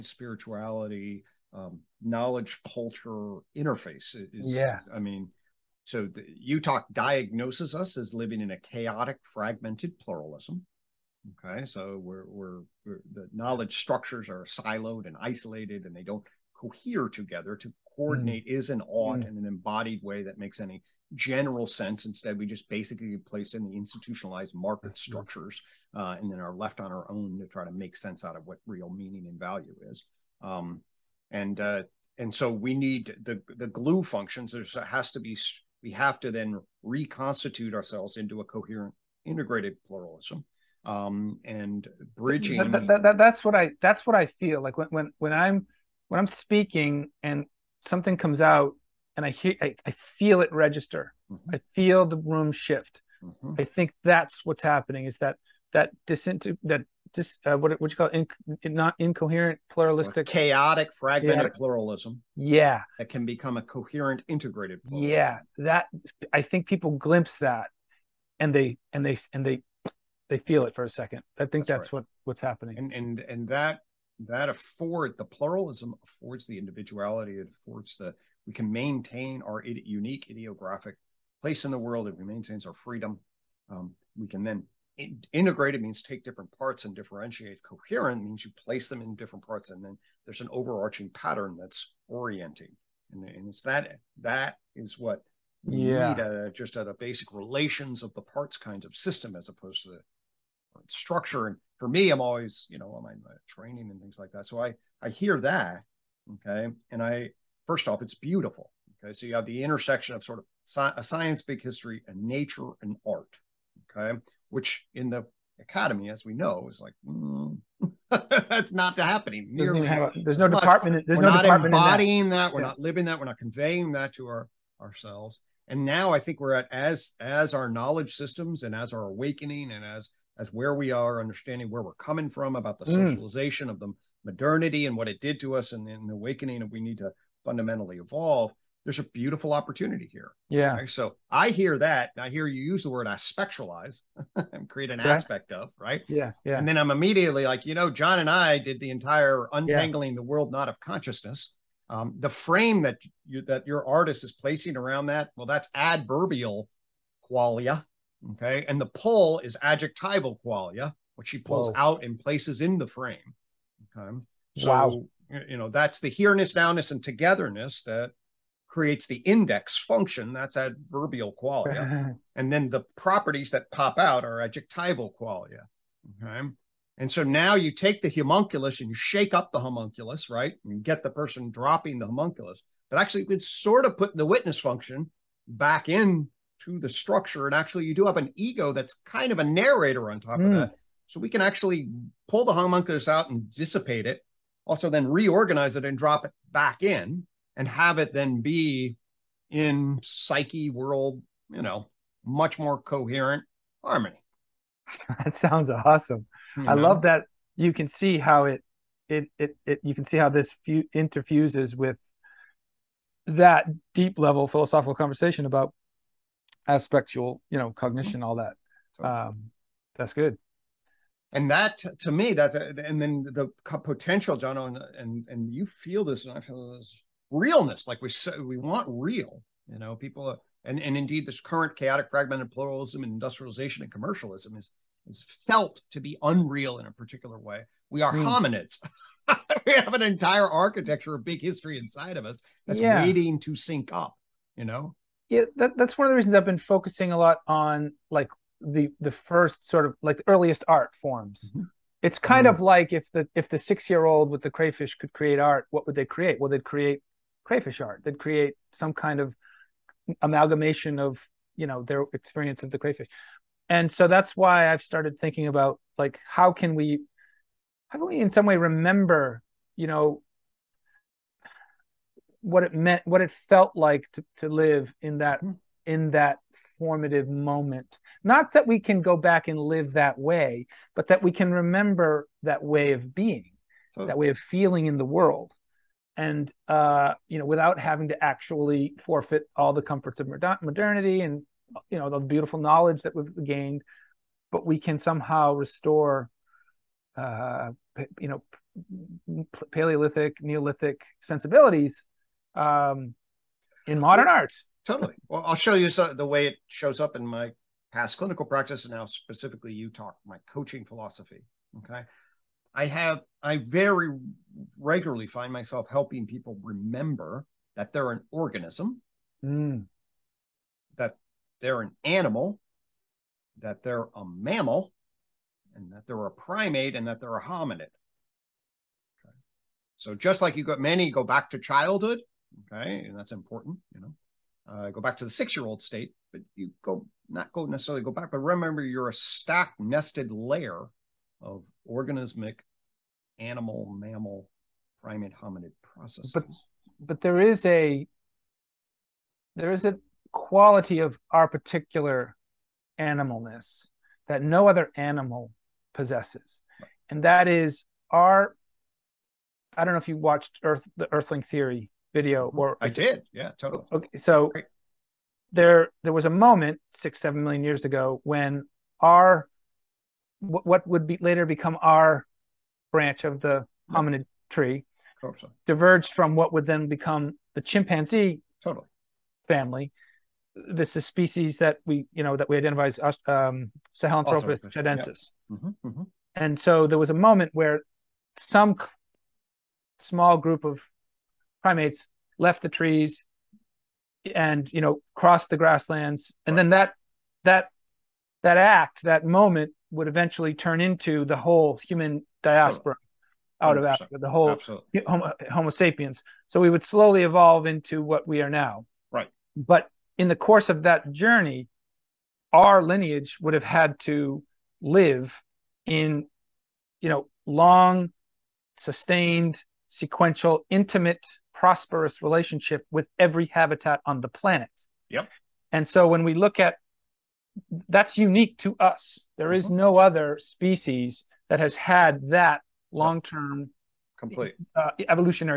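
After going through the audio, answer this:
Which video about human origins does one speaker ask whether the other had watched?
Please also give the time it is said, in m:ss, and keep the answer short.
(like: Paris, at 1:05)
Earthling Theory, at 6:01.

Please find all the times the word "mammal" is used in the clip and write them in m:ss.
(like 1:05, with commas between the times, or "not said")
5:24, 5:43.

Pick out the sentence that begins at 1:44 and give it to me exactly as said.
So I I hear that okay, and I first off it's beautiful.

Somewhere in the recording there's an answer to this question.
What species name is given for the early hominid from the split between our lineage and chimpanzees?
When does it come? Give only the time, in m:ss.
6:23.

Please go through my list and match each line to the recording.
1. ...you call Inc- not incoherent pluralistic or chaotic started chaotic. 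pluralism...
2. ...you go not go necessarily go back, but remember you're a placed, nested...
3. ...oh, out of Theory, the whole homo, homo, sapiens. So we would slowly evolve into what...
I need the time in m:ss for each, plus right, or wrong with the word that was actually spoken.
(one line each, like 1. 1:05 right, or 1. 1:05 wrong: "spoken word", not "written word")
1. 0:57 wrong: "fragmented", not "started"
2. 5:36 wrong: "stacked", not "placed"
3. 6:43 wrong: "Africa", not "Theory".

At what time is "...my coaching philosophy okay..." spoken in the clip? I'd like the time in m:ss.
5:10.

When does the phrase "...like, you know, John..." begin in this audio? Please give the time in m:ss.
2:27.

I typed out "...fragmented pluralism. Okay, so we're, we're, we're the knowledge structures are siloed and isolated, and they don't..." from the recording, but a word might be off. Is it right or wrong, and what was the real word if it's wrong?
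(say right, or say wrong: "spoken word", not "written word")
right.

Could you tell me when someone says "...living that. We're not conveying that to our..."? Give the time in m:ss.
2:02.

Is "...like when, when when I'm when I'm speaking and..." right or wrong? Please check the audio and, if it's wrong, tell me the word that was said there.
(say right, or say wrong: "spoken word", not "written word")
right.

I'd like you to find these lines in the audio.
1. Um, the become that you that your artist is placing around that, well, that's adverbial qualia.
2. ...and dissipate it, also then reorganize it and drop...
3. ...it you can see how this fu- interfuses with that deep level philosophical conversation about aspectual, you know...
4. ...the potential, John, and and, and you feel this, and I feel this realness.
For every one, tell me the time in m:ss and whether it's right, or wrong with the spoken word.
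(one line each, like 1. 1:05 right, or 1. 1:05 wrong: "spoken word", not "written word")
1. 2:31 wrong: "frame", not "become"
2. 3:13 right
3. 3:29 right
4. 3:43 right.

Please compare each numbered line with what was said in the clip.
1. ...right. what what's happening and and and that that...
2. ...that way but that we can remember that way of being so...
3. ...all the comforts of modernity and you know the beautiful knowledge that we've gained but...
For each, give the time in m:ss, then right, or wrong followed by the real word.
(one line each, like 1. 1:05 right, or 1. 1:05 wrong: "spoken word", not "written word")
1. 1:11 right
2. 4:39 right
3. 4:49 right.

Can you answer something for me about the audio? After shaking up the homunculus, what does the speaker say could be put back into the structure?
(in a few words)
the witness function.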